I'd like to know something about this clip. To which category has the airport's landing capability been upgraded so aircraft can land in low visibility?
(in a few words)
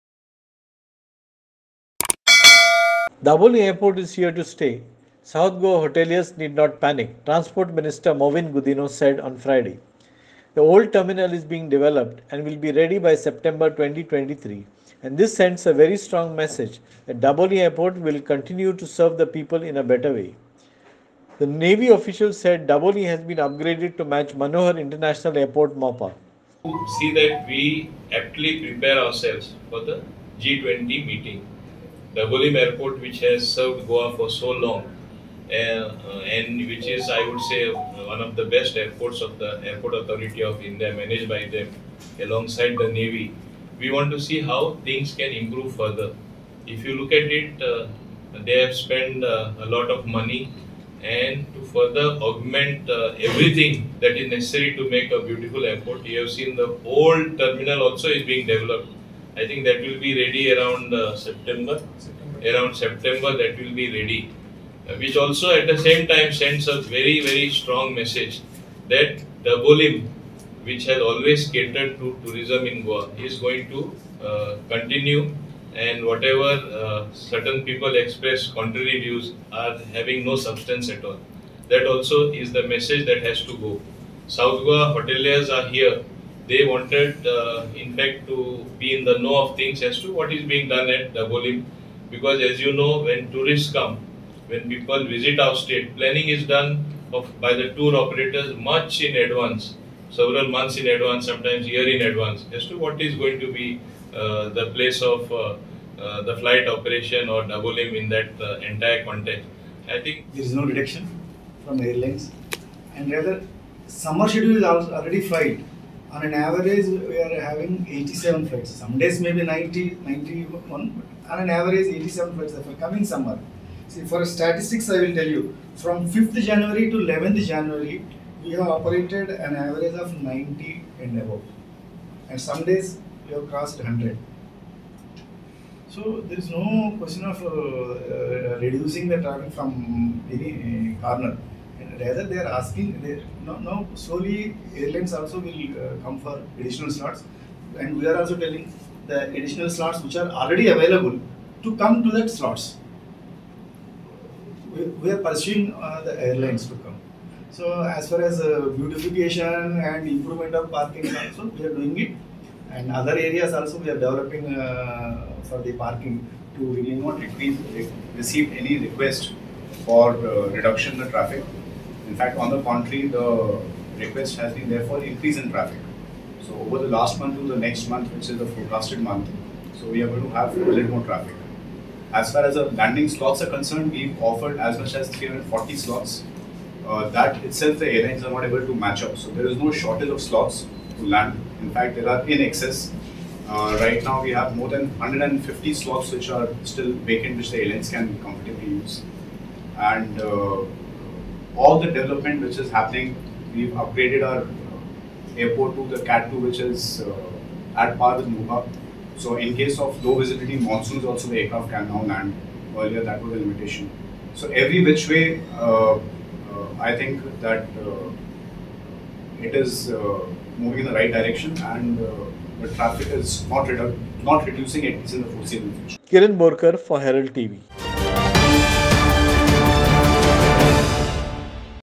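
Cat 2.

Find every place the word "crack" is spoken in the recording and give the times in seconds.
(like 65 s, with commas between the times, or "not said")
not said.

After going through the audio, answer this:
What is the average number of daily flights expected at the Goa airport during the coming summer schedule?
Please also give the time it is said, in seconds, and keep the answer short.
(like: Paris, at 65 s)
87, at 121 s.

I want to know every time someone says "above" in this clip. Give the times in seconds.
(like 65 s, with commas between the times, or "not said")
131 s.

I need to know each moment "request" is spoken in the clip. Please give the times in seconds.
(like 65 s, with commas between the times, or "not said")
168 s, 173 s.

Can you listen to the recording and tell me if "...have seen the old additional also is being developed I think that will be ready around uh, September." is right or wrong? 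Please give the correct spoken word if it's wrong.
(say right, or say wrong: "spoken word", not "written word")
wrong: "terminal", not "additional".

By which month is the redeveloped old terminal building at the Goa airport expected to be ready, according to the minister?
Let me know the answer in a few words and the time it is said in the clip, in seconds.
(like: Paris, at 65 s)
September 2023, at 13 s.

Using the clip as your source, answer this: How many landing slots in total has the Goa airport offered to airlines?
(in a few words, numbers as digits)
340.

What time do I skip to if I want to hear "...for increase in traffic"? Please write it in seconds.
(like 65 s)
174 s.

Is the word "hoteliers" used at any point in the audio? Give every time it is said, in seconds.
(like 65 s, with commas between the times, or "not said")
5 s, 84 s.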